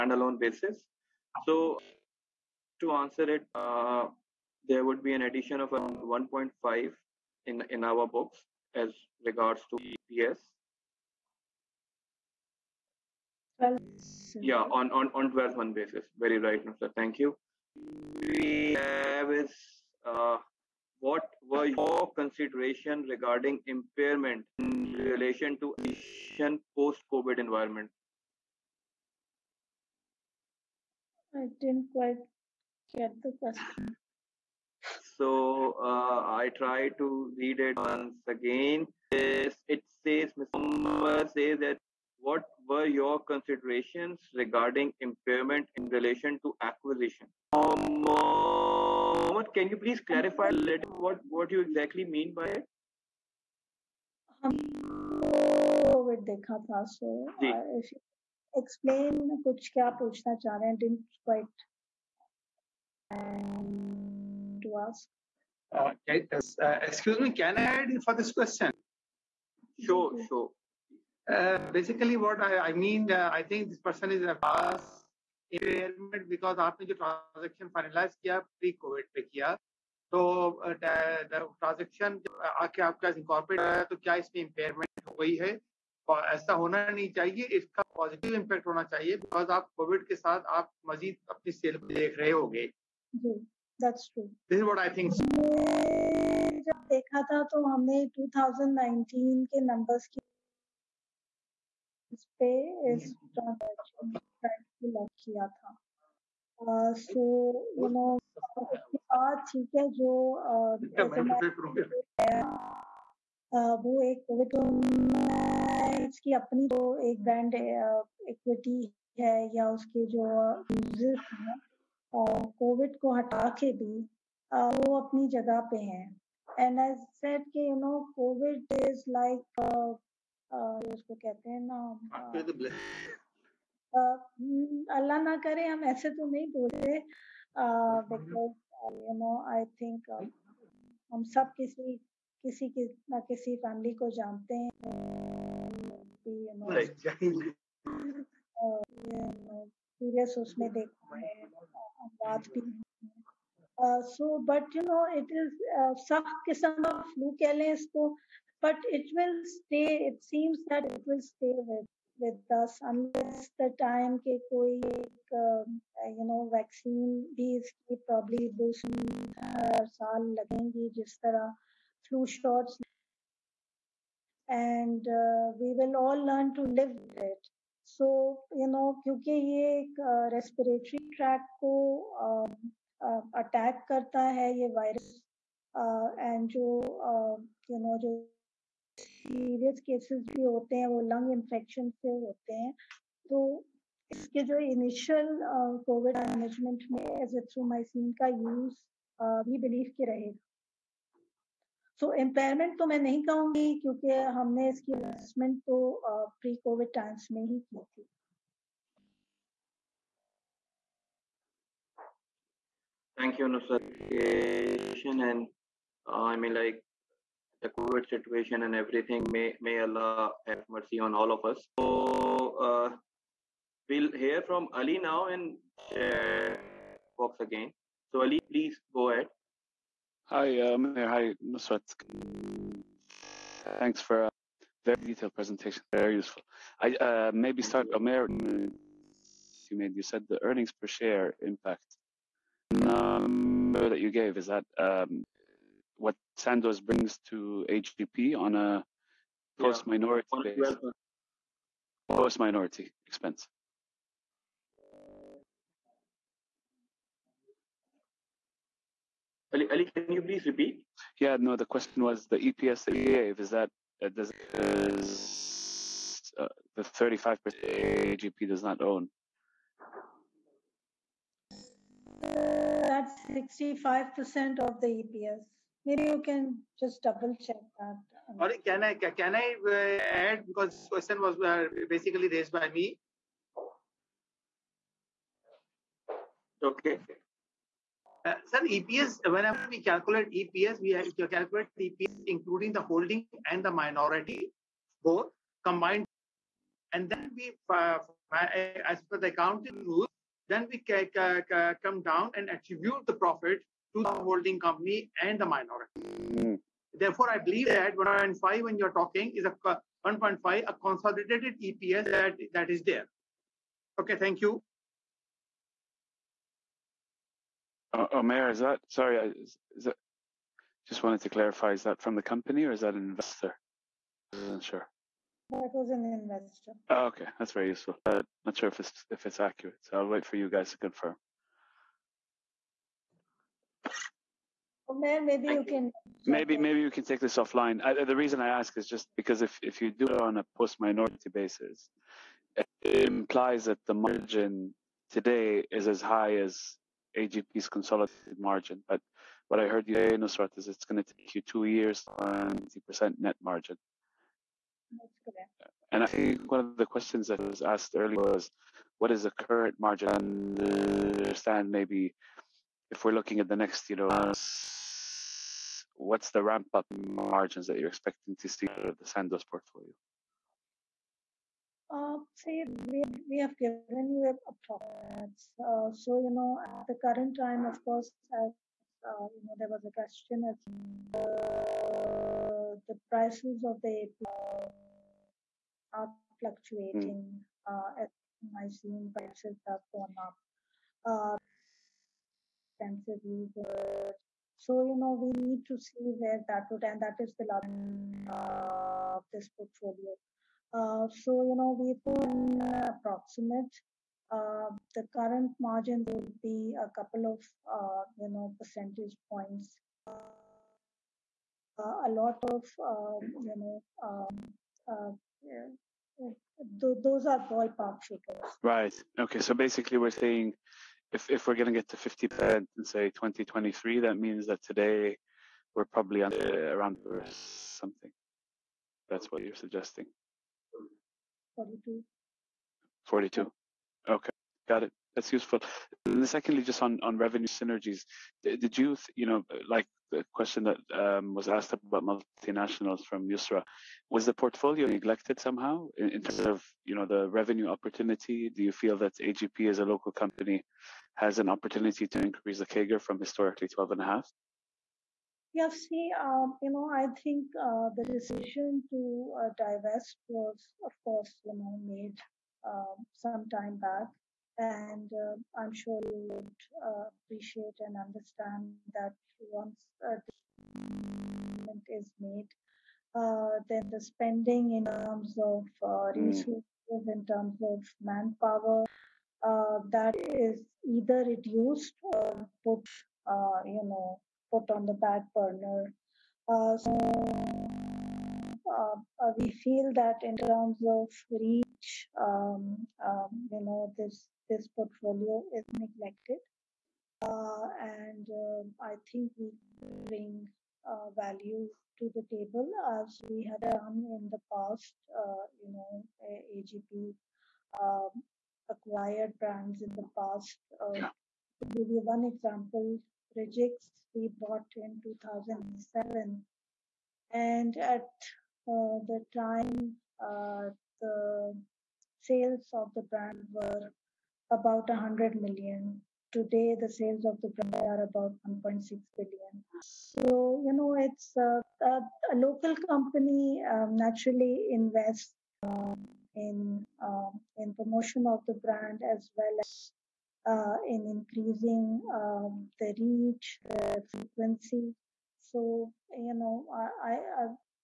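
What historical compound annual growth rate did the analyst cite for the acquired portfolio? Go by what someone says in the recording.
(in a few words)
12.5.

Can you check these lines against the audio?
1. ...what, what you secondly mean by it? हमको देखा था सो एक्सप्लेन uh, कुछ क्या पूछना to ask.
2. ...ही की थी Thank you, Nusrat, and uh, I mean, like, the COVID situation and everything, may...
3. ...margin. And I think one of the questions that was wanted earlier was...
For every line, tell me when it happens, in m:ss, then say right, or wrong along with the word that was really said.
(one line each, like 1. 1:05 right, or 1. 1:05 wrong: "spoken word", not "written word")
1. 0:50 wrong: "exactly", not "secondly"
2. 3:27 right
3. 5:53 wrong: "asked", not "wanted".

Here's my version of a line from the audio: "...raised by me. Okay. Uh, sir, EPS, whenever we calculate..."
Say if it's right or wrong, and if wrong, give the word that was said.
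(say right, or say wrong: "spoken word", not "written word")
right.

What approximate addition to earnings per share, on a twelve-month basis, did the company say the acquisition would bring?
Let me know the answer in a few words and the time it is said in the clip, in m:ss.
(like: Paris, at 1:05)
1.5, at 0:05.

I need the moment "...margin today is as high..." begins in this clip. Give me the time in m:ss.
5:43.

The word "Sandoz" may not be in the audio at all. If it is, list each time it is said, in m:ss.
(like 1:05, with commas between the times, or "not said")
4:06, 6:09.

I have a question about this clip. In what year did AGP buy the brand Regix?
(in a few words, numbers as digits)
2007.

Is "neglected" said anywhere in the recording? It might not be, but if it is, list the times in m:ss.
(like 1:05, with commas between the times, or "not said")
7:24, 8:15.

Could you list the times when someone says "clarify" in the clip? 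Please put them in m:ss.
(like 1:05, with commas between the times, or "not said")
0:50, 5:21.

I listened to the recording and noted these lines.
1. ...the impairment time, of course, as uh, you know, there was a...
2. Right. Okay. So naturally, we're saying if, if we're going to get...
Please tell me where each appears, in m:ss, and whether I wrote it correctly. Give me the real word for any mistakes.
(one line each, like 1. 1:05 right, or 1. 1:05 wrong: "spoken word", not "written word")
1. 6:16 wrong: "current", not "impairment"
2. 6:58 wrong: "basically", not "naturally".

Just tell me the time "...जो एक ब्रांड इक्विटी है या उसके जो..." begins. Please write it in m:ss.
1:56.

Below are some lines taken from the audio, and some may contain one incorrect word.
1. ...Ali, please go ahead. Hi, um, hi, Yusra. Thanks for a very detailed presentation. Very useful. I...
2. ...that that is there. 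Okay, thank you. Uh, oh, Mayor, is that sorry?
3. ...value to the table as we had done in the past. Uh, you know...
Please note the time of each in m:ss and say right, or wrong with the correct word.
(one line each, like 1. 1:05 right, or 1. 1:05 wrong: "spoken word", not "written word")
1. 3:48 wrong: "Nusrat", not "Yusra"
2. 5:12 right
3. 8:21 right.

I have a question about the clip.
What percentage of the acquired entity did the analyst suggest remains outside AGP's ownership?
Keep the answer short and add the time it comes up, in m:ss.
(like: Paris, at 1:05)
35%, at 4:26.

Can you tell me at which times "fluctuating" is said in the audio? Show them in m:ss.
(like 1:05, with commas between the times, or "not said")
6:26.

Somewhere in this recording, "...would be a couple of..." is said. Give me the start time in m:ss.
6:46.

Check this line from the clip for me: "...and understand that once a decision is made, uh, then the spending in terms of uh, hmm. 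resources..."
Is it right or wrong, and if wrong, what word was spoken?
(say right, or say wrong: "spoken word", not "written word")
right.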